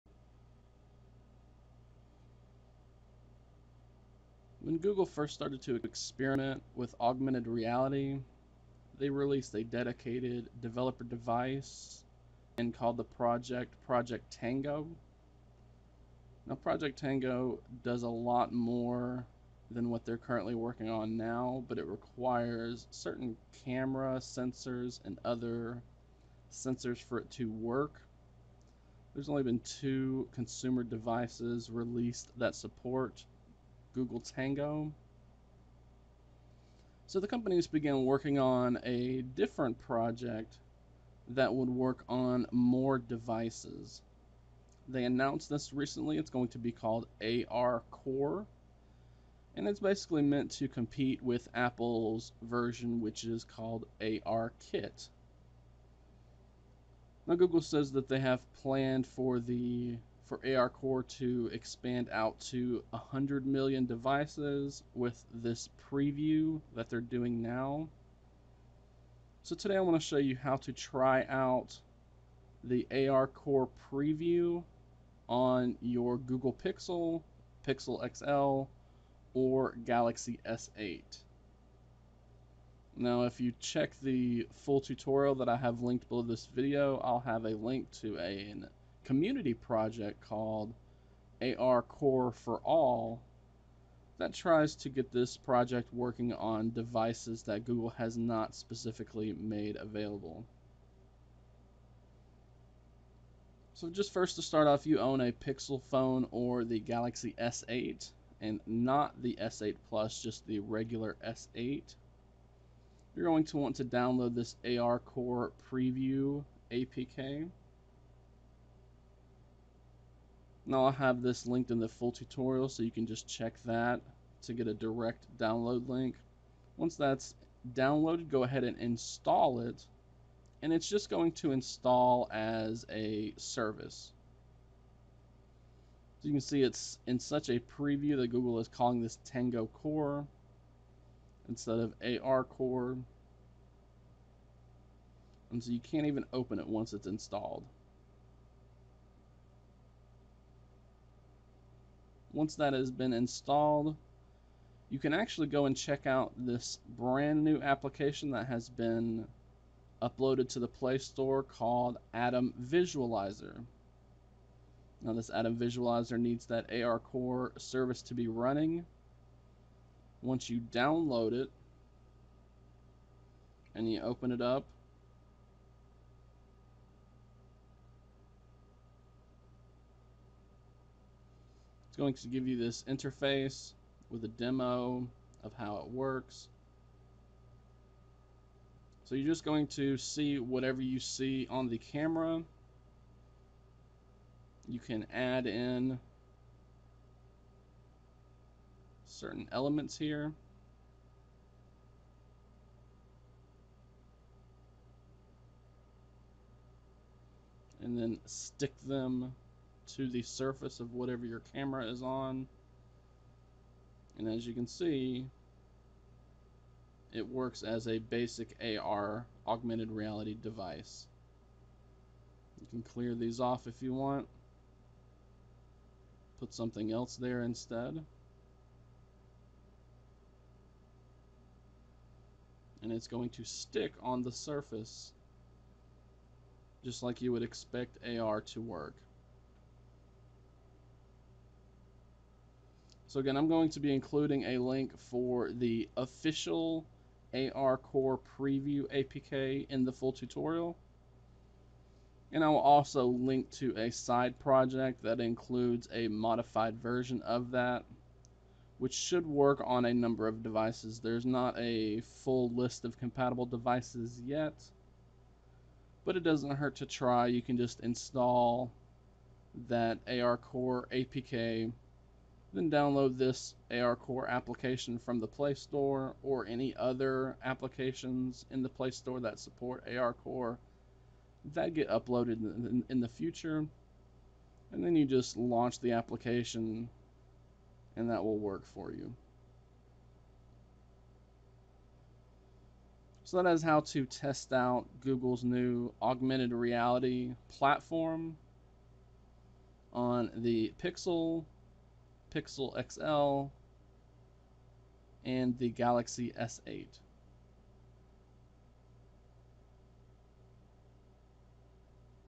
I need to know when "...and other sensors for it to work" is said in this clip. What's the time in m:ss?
0:25.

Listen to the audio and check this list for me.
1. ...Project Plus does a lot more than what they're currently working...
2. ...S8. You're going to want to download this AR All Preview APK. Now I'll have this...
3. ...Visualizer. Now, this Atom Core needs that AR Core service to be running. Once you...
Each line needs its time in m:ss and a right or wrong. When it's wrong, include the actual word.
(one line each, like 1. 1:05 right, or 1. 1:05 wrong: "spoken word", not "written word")
1. 0:16 wrong: "Tango", not "Plus"
2. 1:51 wrong: "Core", not "All"
3. 2:42 wrong: "Visualizer", not "Core".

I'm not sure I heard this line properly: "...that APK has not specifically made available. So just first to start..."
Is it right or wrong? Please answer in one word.
wrong.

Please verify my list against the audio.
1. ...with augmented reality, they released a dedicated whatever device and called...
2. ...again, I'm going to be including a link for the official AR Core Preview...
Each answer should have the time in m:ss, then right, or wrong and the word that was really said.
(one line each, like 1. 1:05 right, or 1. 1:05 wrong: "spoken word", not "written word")
1. 0:06 wrong: "developer", not "whatever"
2. 4:03 right.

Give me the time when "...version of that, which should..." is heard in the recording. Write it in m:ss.
4:16.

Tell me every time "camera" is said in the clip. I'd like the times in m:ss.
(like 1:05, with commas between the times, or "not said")
0:23, 3:11, 3:31.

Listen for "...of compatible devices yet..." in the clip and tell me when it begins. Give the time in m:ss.
4:22.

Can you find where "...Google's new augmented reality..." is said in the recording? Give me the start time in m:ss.
4:55.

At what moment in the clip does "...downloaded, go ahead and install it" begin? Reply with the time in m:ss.
2:07.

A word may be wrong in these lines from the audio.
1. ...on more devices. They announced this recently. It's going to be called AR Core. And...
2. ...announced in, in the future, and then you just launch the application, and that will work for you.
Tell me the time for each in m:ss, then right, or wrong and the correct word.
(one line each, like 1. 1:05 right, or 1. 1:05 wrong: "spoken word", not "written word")
1. 0:42 right
2. 4:41 wrong: "uploaded", not "announced".